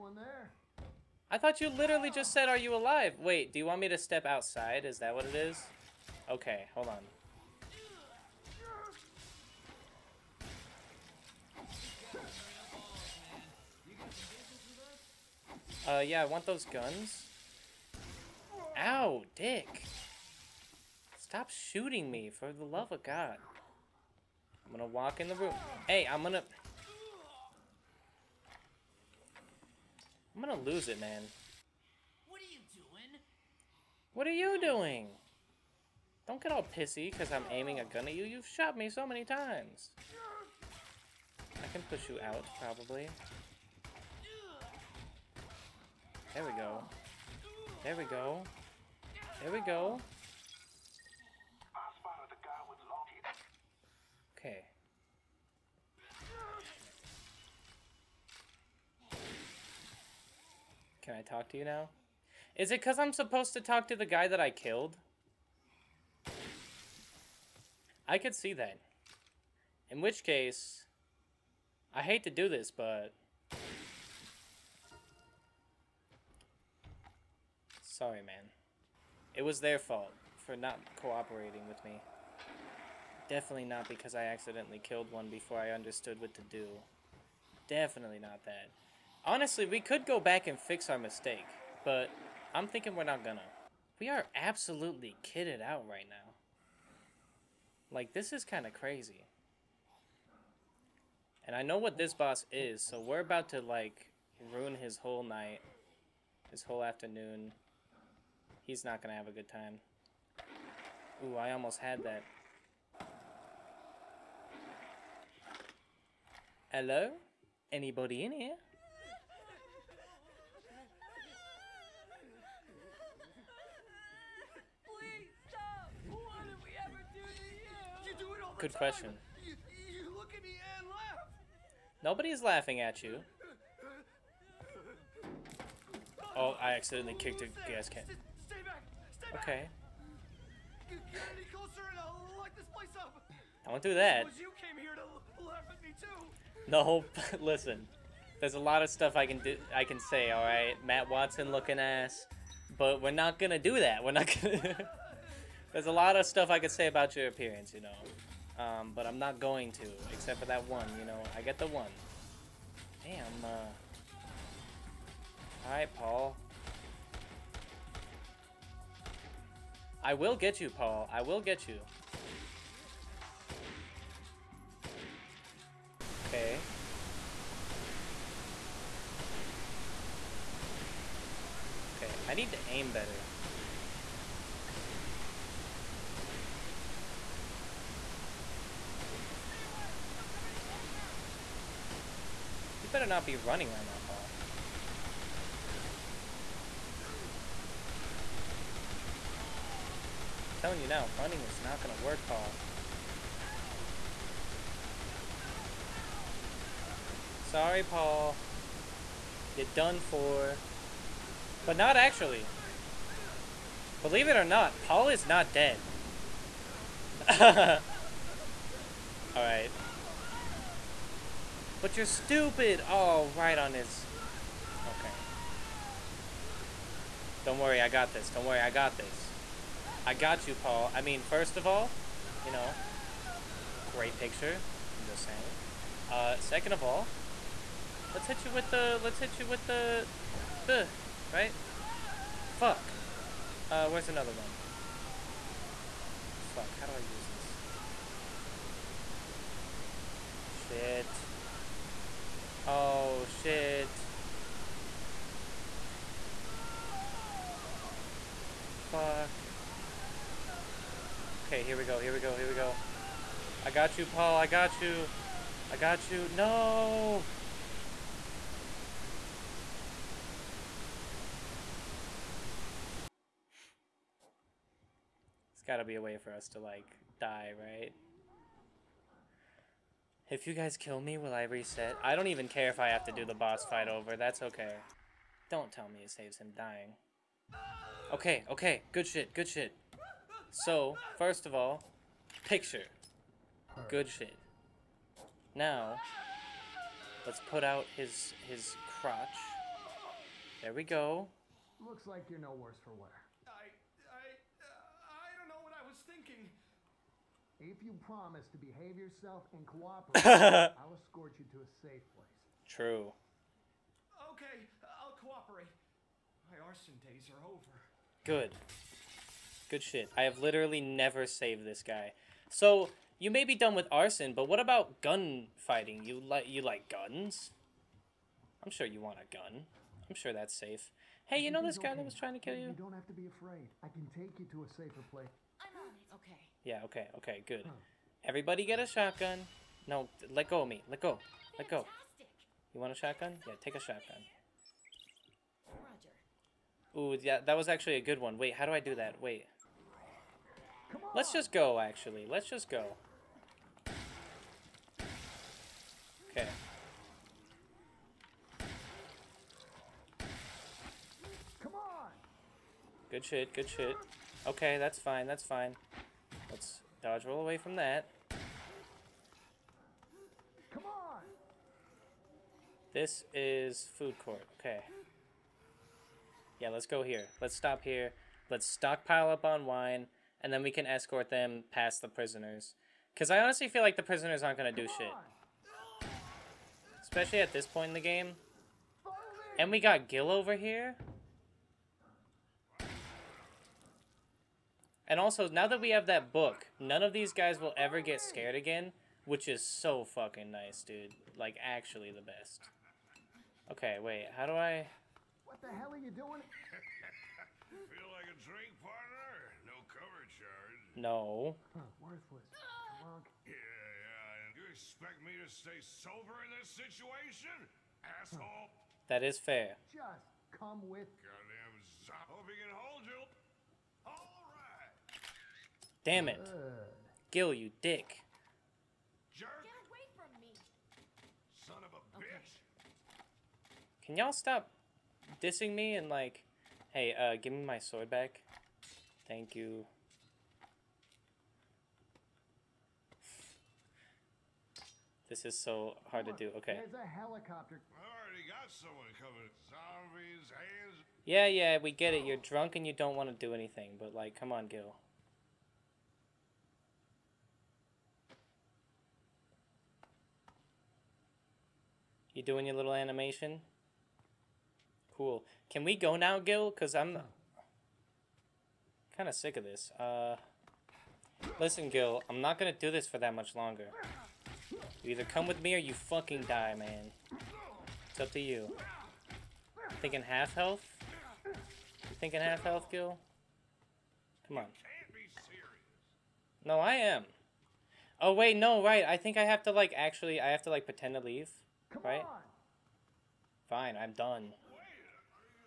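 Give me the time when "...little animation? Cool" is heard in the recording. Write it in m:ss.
7:42.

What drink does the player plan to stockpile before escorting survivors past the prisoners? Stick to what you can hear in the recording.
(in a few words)
wine.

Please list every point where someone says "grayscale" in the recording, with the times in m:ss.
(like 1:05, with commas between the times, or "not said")
not said.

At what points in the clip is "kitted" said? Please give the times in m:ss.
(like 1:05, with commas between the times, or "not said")
1:35.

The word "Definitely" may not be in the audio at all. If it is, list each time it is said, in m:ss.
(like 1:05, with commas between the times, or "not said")
1:23, 1:27.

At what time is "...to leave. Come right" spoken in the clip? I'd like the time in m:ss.
8:11.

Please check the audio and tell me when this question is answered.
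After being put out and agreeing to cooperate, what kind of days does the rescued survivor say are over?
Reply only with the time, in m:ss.
5:16.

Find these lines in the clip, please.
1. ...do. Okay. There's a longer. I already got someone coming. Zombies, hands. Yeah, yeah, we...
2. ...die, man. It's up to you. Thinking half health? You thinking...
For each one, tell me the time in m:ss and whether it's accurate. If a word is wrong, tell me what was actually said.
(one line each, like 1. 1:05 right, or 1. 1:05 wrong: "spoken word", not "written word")
1. 7:26 wrong: "helicopter", not "longer"
2. 7:56 right.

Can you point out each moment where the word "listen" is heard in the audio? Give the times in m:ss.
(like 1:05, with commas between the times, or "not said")
2:27, 7:51.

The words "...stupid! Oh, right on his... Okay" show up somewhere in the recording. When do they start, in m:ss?
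3:42.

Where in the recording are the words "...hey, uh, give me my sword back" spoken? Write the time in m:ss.
7:16.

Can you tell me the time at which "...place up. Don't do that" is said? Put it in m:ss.
2:22.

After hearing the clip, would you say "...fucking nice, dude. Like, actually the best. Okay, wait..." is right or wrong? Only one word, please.
right.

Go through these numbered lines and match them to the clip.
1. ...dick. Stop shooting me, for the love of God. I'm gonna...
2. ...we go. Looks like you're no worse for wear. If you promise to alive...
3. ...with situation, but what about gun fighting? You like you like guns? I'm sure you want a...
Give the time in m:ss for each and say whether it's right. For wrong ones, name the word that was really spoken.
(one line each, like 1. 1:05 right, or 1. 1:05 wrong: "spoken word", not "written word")
1. 0:19 right
2. 5:00 wrong: "behave", not "alive"
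3. 5:23 wrong: "arson", not "situation".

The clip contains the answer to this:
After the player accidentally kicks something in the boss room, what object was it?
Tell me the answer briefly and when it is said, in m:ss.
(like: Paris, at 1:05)
gas can, at 2:17.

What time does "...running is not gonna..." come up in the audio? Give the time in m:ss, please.
3:21.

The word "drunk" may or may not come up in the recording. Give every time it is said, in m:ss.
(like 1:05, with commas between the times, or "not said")
7:32.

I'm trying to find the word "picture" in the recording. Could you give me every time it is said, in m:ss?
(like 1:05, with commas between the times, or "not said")
3:54, 4:52.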